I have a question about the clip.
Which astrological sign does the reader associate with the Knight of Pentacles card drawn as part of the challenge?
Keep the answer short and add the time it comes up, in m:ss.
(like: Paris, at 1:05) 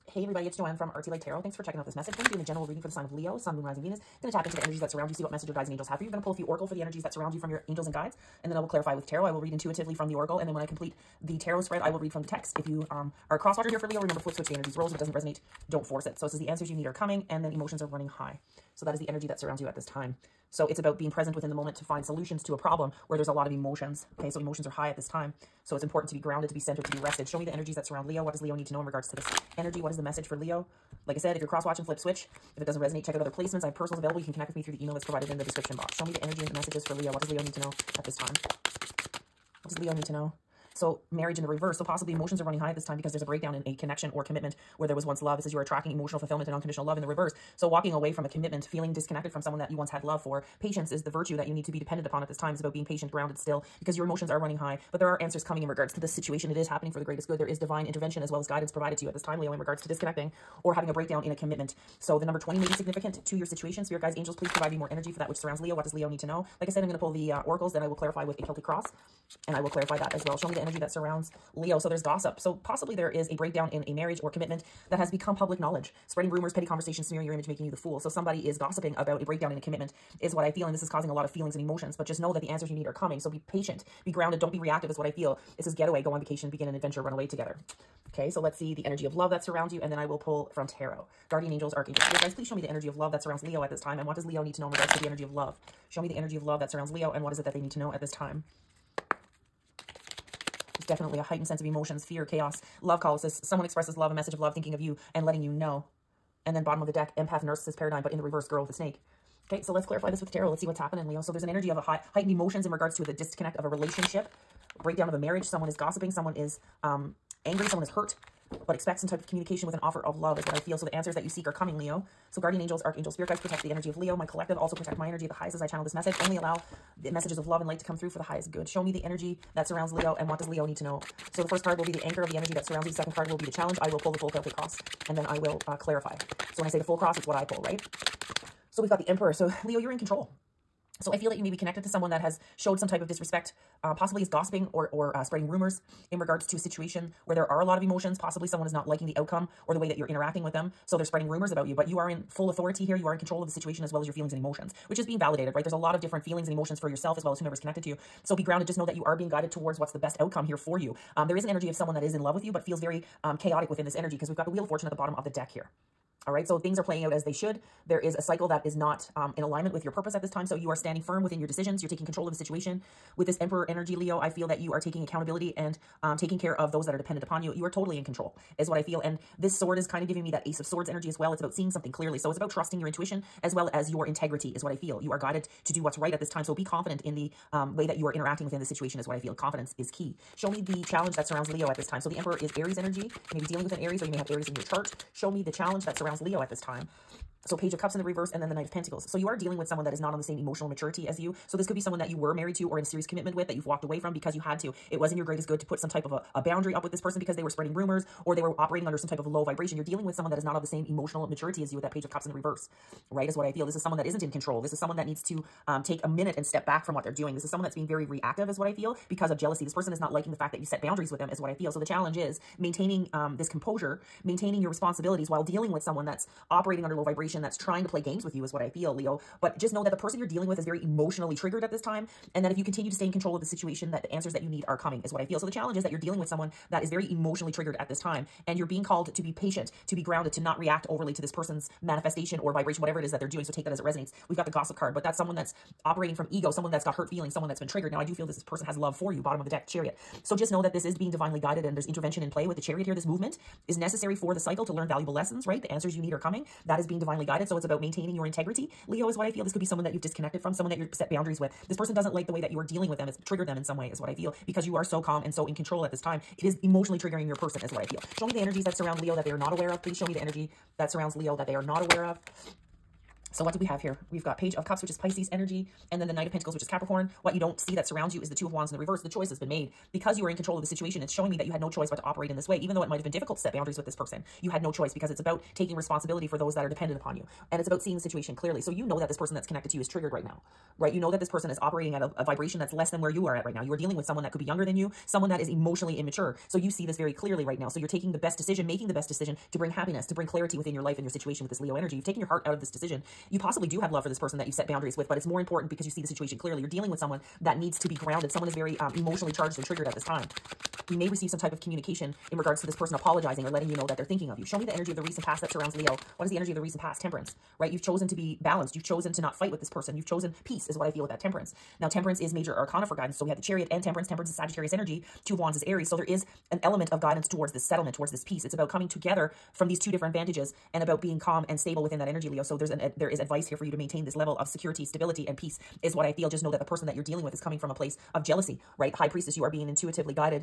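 Capricorn, at 4:36.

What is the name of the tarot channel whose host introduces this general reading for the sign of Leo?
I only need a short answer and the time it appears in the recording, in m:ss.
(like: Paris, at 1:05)
Artsylight Tarot, at 0:00.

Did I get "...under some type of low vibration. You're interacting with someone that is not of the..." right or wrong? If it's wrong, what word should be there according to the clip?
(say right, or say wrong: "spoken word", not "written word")
wrong: "dealing", not "interacting".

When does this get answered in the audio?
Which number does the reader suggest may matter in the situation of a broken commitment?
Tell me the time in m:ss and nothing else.
1:02.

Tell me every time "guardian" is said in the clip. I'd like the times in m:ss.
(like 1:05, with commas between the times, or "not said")
1:31, 2:02.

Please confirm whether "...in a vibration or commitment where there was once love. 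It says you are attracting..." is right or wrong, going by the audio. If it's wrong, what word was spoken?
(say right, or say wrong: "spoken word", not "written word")
wrong: "connection", not "vibration".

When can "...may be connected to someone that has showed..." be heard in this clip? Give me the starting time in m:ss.
2:21.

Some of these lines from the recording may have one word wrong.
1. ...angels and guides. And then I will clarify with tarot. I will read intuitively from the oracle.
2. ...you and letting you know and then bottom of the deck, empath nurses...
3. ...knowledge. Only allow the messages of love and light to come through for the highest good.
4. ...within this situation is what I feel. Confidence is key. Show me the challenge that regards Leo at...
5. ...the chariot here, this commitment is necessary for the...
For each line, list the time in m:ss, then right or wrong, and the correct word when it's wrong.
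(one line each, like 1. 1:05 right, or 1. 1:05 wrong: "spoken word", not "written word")
1. 0:07 right
2. 1:44 right
3. 2:05 wrong: "message", not "knowledge"
4. 3:08 wrong: "surrounds", not "regards"
5. 4:12 wrong: "movement", not "commitment".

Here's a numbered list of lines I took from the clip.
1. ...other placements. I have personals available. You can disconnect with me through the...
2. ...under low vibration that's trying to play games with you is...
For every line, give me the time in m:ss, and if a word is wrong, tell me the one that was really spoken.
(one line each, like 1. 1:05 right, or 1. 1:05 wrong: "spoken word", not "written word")
1. 0:33 wrong: "connect", not "disconnect"
2. 3:46 right.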